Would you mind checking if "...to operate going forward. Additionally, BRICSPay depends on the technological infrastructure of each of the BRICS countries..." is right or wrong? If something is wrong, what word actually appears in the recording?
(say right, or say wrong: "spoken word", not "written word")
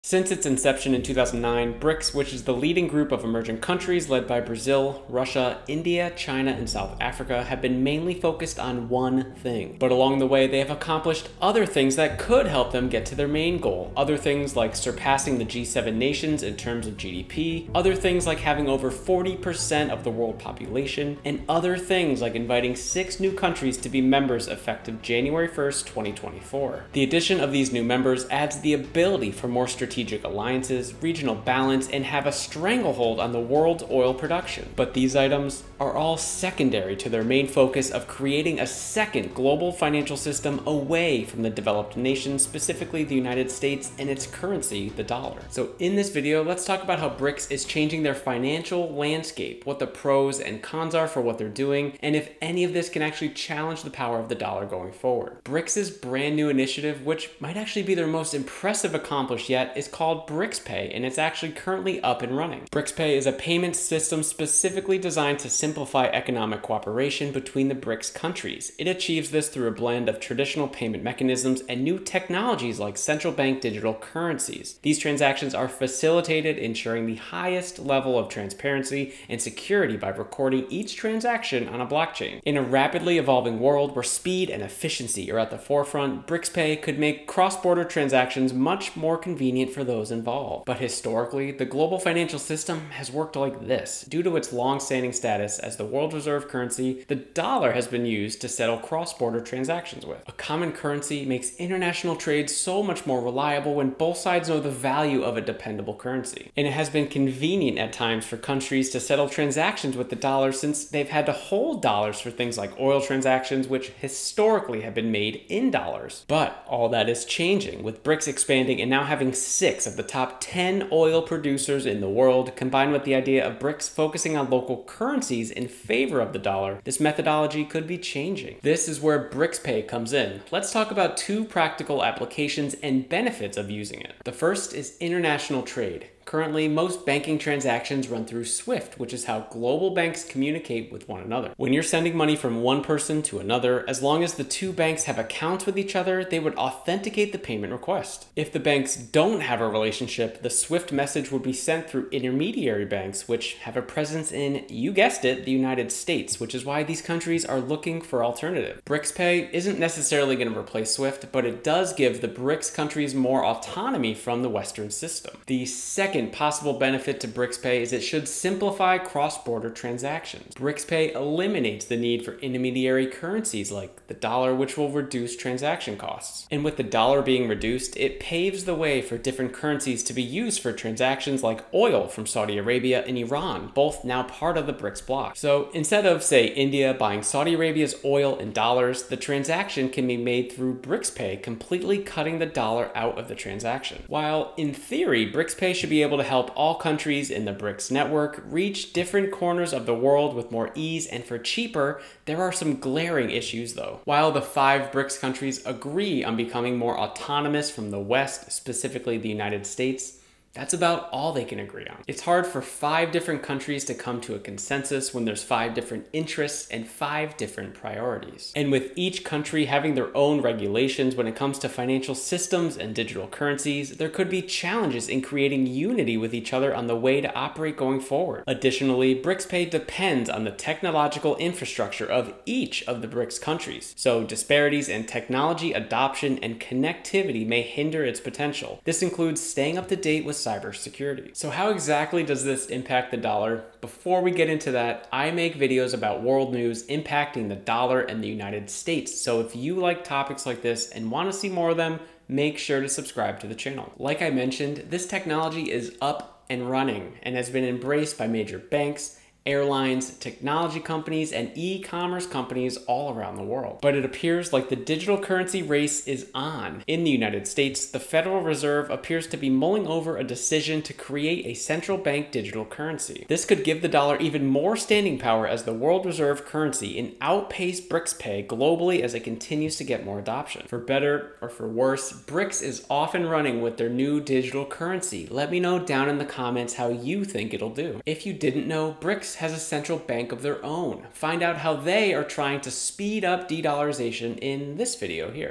right.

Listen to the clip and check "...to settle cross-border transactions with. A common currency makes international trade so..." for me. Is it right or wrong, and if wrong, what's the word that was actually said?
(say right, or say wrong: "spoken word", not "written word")
right.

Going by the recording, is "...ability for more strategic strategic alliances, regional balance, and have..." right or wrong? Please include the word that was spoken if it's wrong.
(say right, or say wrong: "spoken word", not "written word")
right.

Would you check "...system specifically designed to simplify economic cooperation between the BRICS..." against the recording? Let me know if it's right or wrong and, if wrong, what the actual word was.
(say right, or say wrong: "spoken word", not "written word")
right.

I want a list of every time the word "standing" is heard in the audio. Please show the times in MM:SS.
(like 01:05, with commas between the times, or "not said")
01:34, 04:34.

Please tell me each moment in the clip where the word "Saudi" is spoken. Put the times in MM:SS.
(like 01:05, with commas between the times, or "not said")
03:02, 03:07.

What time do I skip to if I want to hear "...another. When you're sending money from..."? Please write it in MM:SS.
02:21.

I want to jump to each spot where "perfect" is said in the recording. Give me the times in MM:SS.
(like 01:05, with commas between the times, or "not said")
not said.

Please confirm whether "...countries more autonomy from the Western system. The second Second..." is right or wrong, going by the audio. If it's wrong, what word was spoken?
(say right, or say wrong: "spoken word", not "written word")
right.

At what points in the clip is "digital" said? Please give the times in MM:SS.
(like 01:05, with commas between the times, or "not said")
01:13, 03:42, 04:24, 04:32, 04:44.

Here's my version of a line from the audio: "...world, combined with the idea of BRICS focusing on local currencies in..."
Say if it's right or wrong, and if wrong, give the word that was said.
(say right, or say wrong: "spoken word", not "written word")
right.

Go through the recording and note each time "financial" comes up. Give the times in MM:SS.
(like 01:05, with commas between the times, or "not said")
00:39, 00:48, 01:31, 03:41.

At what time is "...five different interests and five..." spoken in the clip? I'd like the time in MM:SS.
03:35.